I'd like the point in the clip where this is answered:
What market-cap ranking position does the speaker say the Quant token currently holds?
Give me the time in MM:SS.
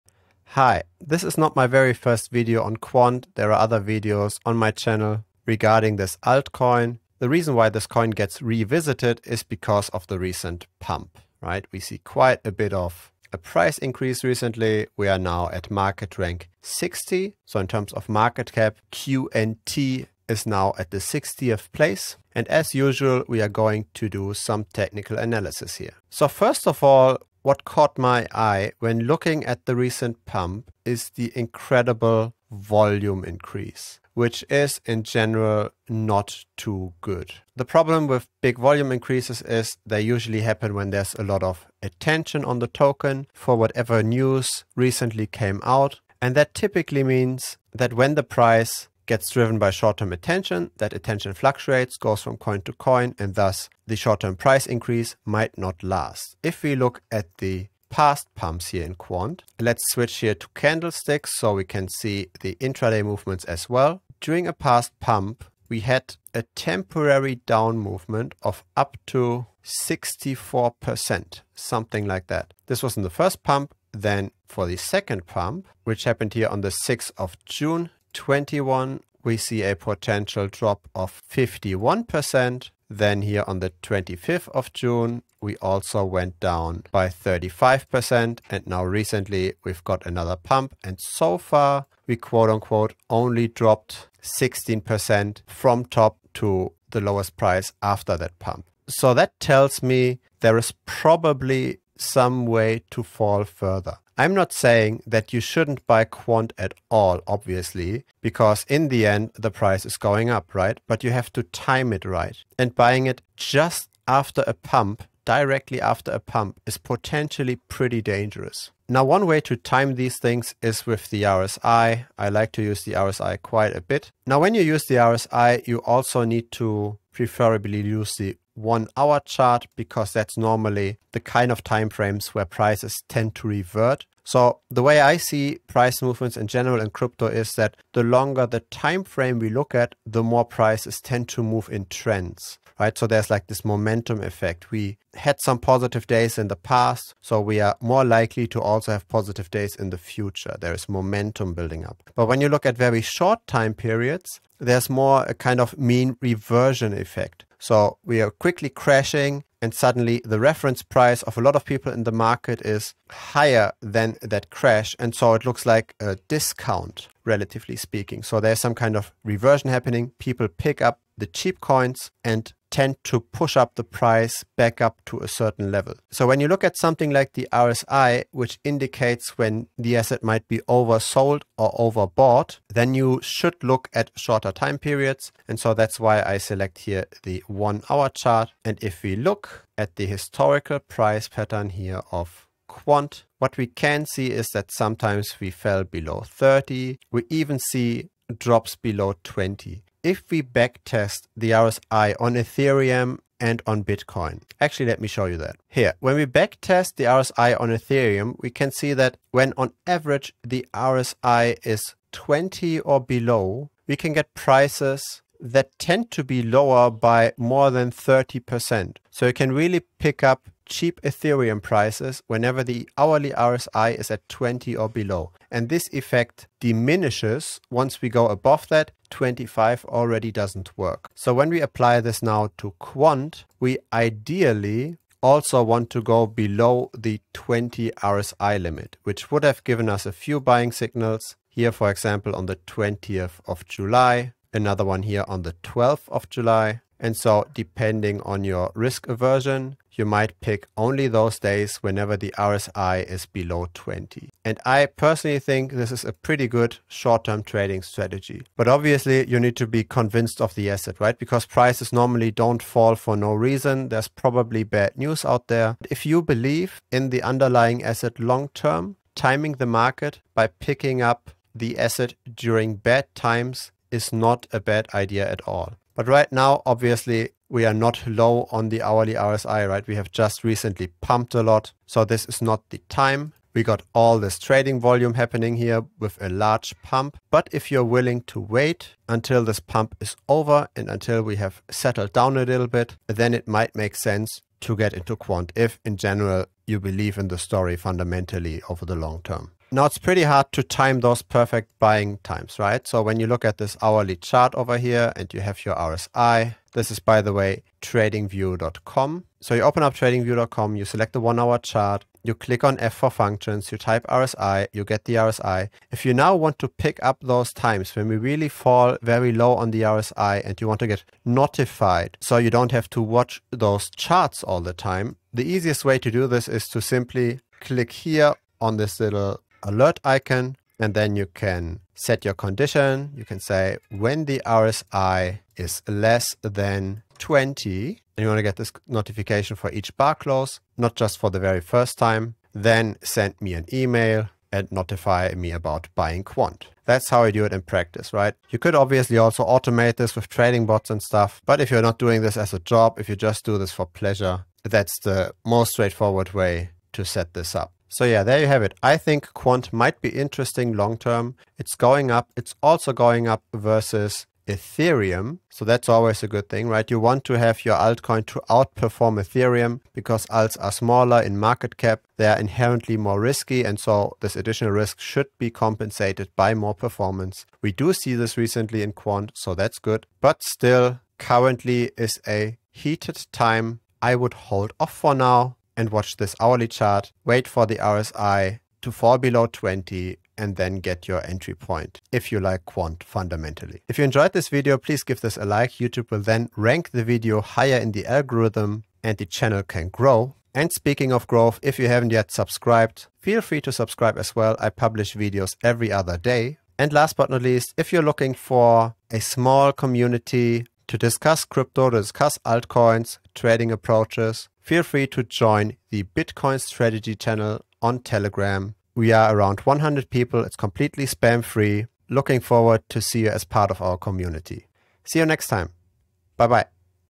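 00:15.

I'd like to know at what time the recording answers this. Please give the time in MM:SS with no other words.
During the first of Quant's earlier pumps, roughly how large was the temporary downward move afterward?
01:09.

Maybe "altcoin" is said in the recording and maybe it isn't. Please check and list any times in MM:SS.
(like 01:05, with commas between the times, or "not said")
00:06, 06:07, 06:52.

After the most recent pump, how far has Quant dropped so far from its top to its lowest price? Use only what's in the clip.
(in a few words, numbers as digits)
16%.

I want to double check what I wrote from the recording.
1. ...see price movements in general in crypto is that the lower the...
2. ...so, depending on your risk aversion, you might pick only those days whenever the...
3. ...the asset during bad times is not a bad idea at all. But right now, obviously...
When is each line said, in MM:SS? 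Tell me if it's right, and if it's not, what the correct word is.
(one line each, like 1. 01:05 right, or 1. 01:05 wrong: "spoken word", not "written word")
1. 02:15 wrong: "longer", not "lower"
2. 04:07 right
3. 04:31 right.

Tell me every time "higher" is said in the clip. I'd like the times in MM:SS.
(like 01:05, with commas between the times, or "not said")
02:43, 06:37.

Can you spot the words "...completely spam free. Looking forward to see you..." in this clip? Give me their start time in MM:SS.
07:00.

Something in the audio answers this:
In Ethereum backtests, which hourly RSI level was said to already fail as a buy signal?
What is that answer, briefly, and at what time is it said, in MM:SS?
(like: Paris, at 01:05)
25, at 03:49.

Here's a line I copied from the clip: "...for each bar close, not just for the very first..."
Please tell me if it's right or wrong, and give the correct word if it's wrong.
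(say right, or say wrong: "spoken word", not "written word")
right.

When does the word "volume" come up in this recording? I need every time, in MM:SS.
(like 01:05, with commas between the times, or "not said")
00:32, 00:38, 04:44.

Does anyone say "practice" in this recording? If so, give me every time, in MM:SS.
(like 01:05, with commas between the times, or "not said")
05:47.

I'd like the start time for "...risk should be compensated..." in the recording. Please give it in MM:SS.
06:14.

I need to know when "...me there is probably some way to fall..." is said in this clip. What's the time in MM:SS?
01:39.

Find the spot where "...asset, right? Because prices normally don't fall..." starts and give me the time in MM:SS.
04:20.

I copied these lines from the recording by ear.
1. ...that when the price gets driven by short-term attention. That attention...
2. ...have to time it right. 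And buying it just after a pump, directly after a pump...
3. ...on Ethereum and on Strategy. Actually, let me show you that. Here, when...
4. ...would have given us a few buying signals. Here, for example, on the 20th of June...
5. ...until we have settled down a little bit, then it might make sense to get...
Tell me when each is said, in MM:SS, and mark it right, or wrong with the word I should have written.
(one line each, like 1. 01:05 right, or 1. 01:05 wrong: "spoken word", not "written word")
1. 00:47 right
2. 01:51 right
3. 03:22 wrong: "Bitcoin", not "Strategy"
4. 03:59 wrong: "July", not "June"
5. 04:50 right.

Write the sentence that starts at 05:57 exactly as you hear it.
So yeah, there you have it.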